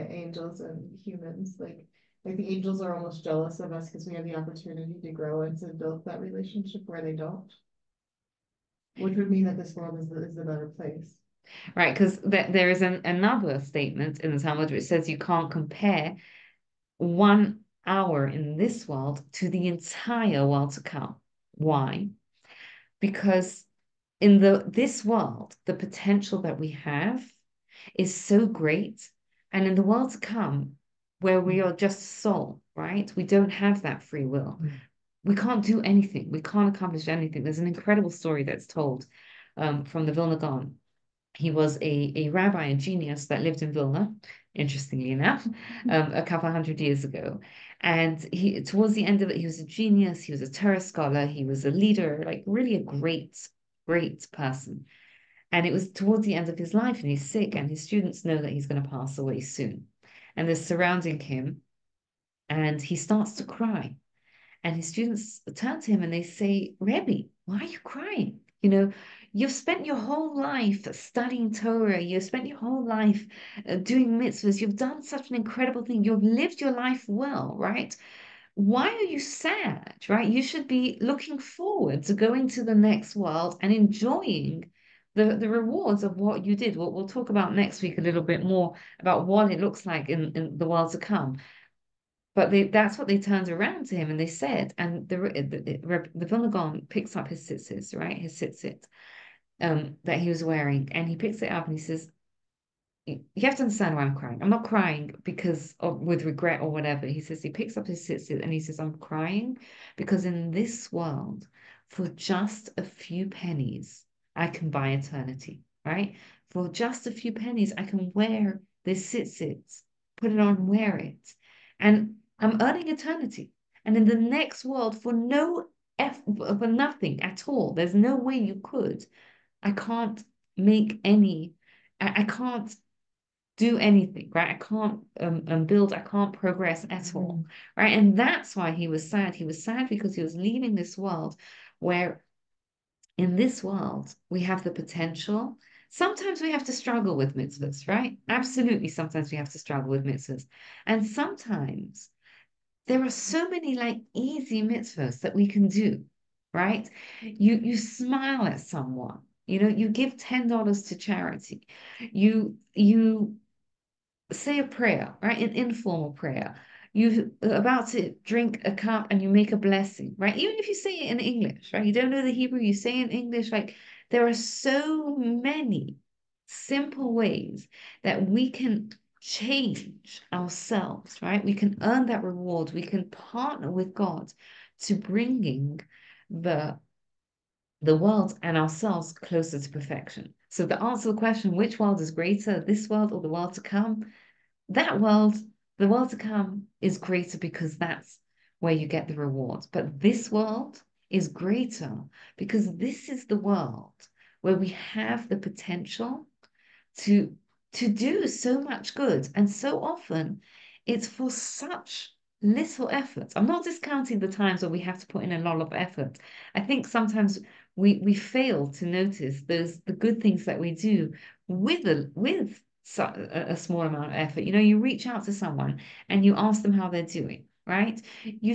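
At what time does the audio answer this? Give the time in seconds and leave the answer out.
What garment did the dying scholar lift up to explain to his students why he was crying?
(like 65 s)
97 s.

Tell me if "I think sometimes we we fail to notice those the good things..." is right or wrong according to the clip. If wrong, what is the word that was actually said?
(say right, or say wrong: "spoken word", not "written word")
right.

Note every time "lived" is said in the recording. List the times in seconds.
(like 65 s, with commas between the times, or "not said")
43 s, 76 s.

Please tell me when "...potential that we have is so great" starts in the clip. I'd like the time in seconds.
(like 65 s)
25 s.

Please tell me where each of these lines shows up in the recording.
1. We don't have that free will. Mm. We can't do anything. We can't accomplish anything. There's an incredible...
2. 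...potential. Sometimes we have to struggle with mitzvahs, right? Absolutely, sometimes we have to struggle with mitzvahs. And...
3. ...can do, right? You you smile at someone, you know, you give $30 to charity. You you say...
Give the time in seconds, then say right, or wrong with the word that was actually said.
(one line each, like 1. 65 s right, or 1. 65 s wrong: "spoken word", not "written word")
1. 33 s right
2. 144 s right
3. 155 s wrong: "10", not "30".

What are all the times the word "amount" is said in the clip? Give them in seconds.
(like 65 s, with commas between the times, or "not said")
223 s.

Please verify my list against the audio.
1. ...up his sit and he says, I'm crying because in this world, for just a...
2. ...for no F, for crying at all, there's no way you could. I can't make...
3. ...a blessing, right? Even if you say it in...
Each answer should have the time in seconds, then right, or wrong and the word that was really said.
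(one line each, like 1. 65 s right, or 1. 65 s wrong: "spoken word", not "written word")
1. 107 s right
2. 125 s wrong: "nothing", not "crying"
3. 169 s right.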